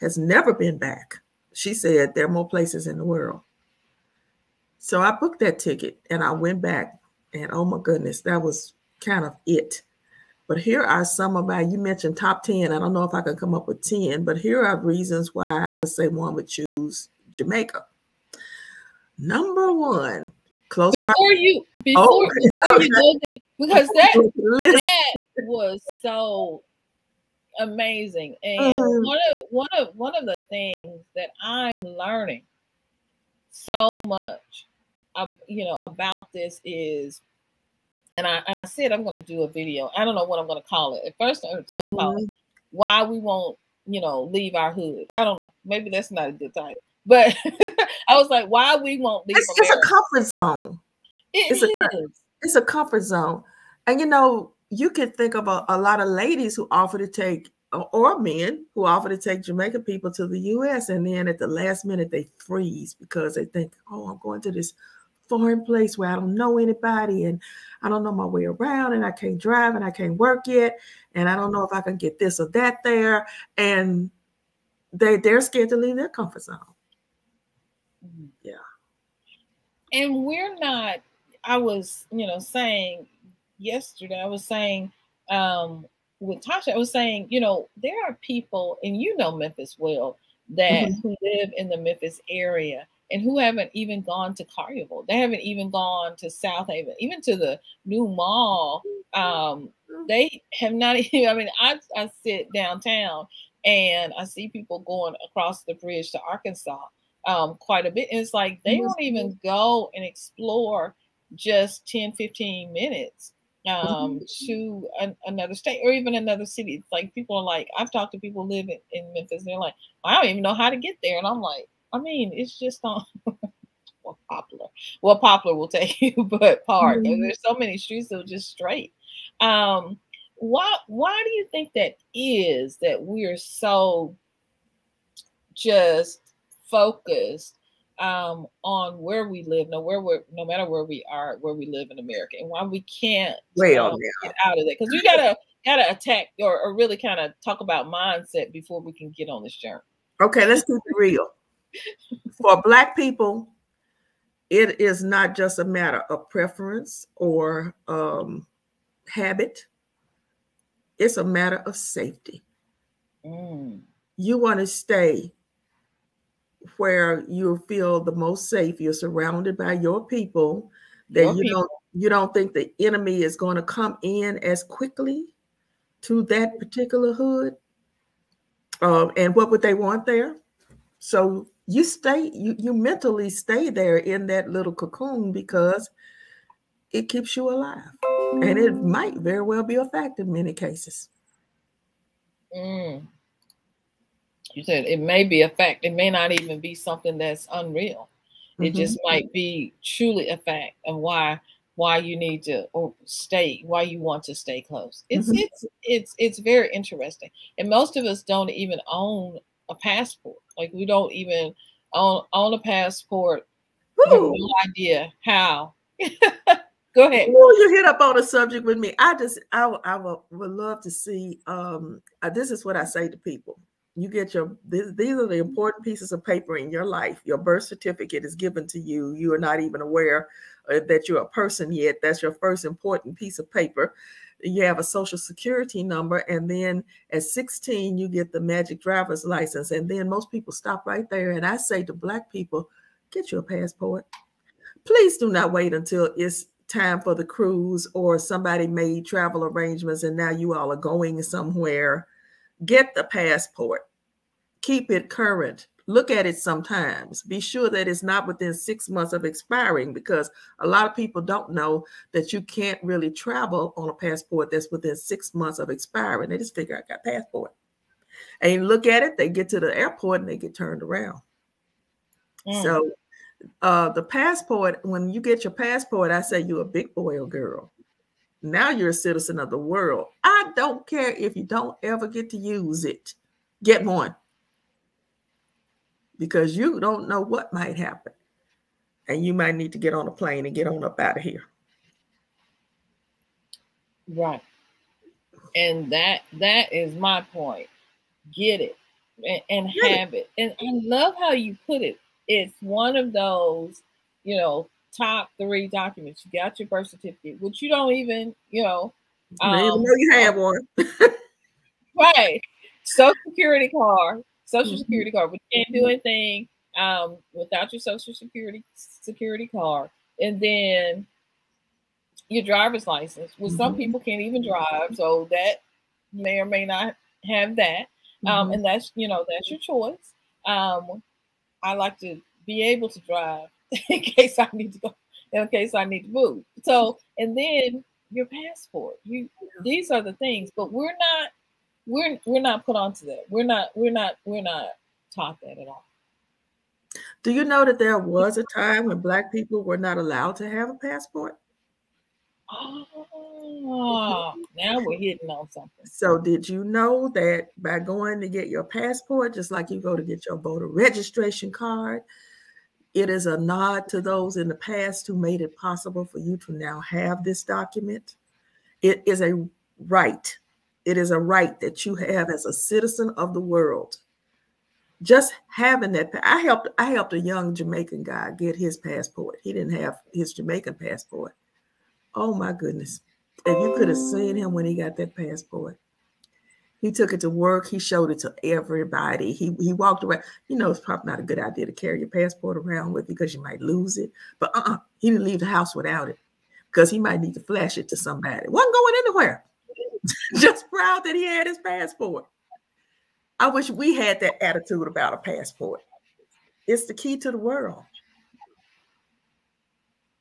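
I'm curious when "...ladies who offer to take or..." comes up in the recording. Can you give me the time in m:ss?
0:56.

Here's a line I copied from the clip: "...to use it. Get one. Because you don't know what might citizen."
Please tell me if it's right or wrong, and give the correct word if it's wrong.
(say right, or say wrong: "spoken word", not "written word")
wrong: "happen", not "citizen".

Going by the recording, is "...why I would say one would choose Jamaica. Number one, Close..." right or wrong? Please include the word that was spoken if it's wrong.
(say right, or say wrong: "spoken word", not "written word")
right.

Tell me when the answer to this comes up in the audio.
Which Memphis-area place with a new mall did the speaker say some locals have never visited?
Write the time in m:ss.
1:36.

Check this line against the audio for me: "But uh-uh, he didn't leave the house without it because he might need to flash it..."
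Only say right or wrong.
right.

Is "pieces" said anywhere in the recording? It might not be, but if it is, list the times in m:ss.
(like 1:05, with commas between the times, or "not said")
3:45, 3:53.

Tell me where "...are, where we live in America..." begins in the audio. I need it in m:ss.
2:21.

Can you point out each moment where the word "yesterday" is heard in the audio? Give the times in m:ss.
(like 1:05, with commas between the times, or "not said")
1:23.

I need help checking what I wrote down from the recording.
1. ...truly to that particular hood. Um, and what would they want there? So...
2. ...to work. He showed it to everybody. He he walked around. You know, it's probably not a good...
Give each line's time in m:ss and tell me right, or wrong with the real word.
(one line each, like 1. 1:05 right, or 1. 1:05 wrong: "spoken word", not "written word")
1. 2:54 wrong: "quickly", not "truly"
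2. 6:27 right.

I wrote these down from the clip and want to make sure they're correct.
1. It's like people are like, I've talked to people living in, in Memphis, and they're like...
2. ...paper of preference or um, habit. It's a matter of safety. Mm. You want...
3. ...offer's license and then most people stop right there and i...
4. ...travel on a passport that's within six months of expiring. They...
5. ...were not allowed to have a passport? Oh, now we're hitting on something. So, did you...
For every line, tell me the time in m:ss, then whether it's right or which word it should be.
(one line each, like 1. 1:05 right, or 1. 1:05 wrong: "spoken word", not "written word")
1. 1:56 right
2. 2:35 wrong: "matter", not "paper"
3. 3:58 wrong: "driver", not "offer"
4. 4:23 right
5. 5:49 right.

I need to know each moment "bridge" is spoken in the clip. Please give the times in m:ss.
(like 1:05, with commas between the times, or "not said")
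1:45.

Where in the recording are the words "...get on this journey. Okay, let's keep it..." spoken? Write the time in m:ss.
2:29.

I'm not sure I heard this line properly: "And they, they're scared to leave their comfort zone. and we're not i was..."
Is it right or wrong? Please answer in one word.
right.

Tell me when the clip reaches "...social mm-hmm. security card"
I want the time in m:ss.
5:14.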